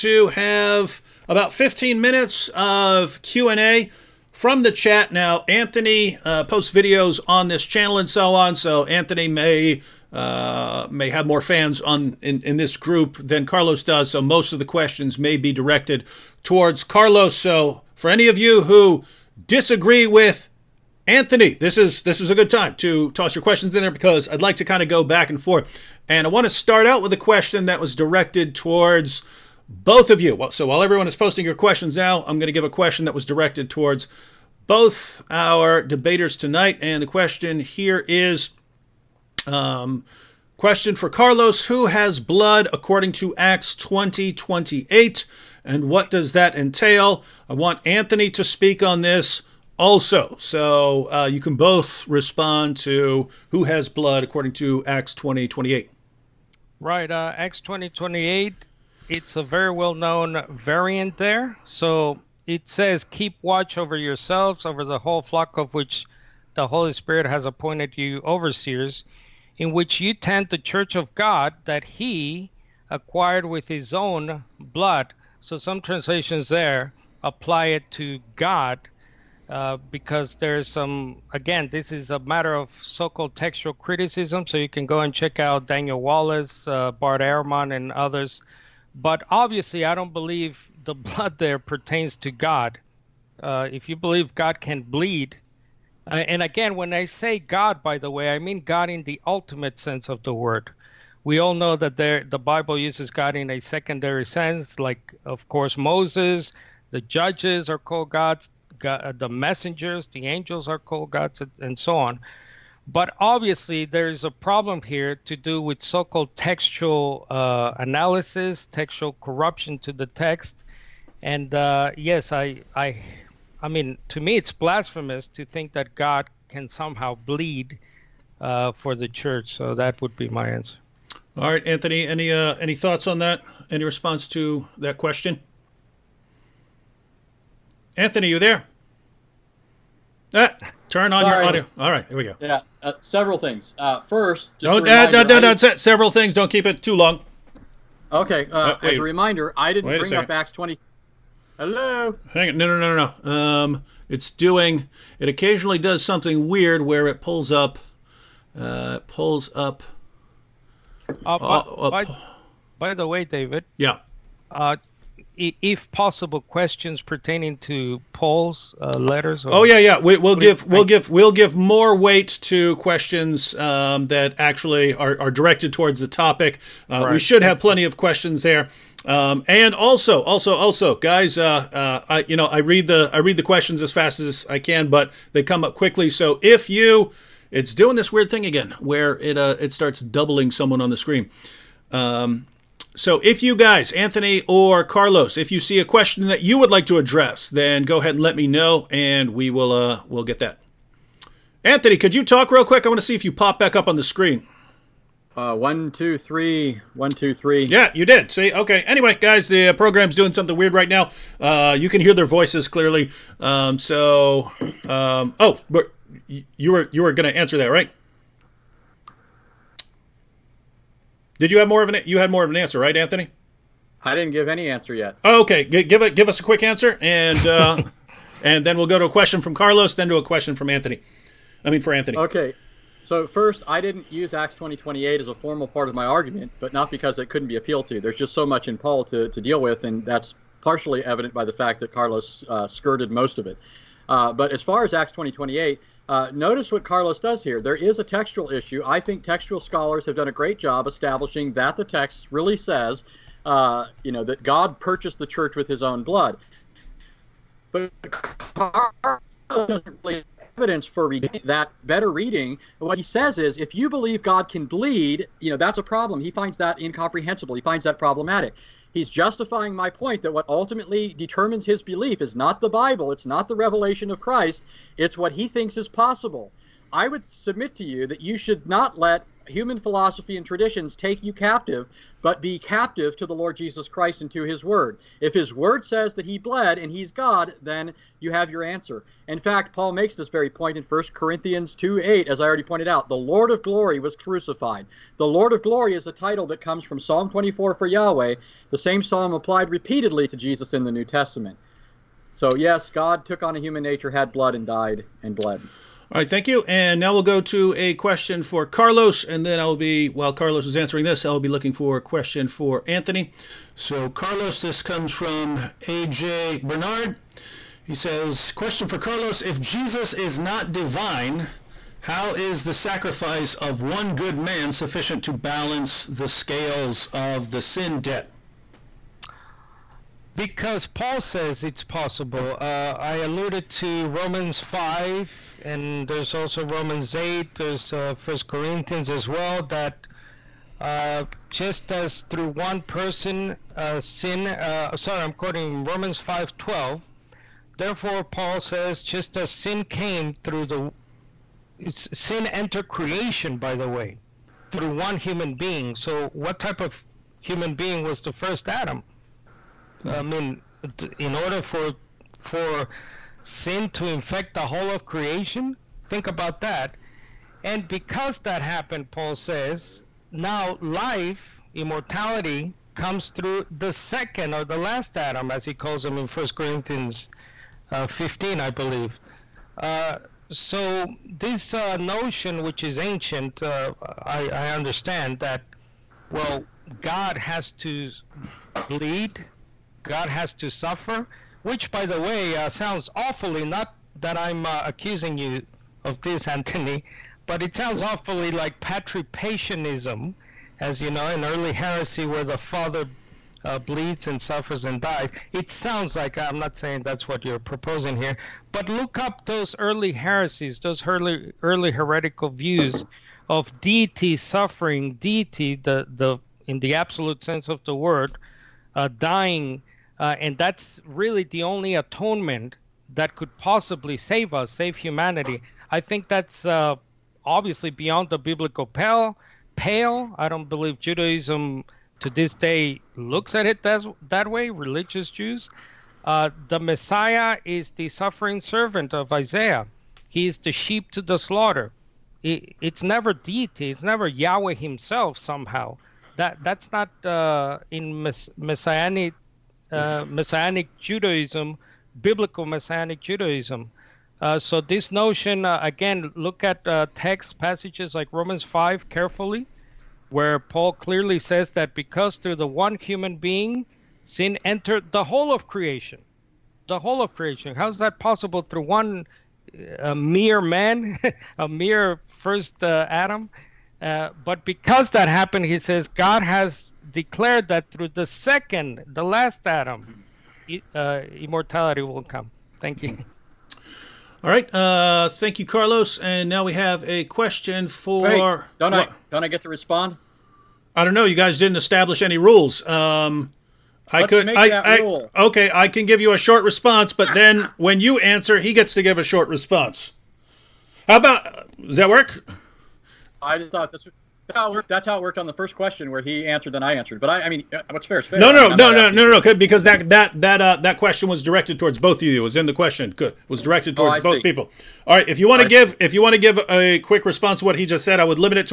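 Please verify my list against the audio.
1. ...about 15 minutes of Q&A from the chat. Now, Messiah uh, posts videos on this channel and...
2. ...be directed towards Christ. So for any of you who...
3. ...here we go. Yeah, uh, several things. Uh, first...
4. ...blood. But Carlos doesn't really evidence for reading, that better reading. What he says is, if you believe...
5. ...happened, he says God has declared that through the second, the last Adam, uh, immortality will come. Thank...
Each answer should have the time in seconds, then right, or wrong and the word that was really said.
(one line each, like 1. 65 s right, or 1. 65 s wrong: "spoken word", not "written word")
1. 1 s wrong: "Anthony", not "Messiah"
2. 15 s wrong: "Carlos", not "Christ"
3. 142 s right
4. 256 s right
5. 475 s right.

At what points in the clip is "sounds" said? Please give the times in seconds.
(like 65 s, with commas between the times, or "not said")
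392 s, 397 s, 405 s.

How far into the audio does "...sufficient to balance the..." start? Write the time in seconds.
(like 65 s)
324 s.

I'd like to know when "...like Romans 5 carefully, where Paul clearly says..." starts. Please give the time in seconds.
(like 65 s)
458 s.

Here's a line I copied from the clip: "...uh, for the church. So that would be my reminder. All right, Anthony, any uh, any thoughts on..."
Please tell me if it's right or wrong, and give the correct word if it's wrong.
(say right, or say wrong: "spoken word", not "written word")
wrong: "answer", not "reminder".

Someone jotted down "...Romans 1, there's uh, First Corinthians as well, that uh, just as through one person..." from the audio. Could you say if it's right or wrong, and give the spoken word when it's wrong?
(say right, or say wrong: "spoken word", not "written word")
wrong: "8", not "1".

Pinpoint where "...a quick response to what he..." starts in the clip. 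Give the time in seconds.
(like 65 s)
516 s.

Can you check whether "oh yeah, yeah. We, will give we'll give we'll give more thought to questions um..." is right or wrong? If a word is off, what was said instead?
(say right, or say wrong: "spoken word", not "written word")
wrong: "weight", not "thought".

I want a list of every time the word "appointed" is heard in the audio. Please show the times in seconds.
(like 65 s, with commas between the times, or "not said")
67 s.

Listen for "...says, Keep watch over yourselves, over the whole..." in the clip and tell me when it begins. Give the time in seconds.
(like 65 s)
62 s.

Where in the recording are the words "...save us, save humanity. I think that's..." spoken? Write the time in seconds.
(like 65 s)
424 s.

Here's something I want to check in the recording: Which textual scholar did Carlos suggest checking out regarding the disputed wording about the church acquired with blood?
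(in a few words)
Daniel Wallace.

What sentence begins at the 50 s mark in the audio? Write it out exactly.
So uh, you can both respond to who has blood according to Acts 20 28.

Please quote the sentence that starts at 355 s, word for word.
So, what type of human being was the first Adam?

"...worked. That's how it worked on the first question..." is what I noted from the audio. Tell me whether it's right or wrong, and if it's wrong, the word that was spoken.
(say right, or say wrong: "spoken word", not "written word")
right.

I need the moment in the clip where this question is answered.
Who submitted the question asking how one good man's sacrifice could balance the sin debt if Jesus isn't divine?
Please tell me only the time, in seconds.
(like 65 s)
315 s.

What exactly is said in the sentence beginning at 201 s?
Anthony, could you talk real quick?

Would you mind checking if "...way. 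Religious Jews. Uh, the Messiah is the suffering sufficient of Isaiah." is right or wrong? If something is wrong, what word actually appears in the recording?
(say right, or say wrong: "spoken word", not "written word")
wrong: "servant", not "sufficient".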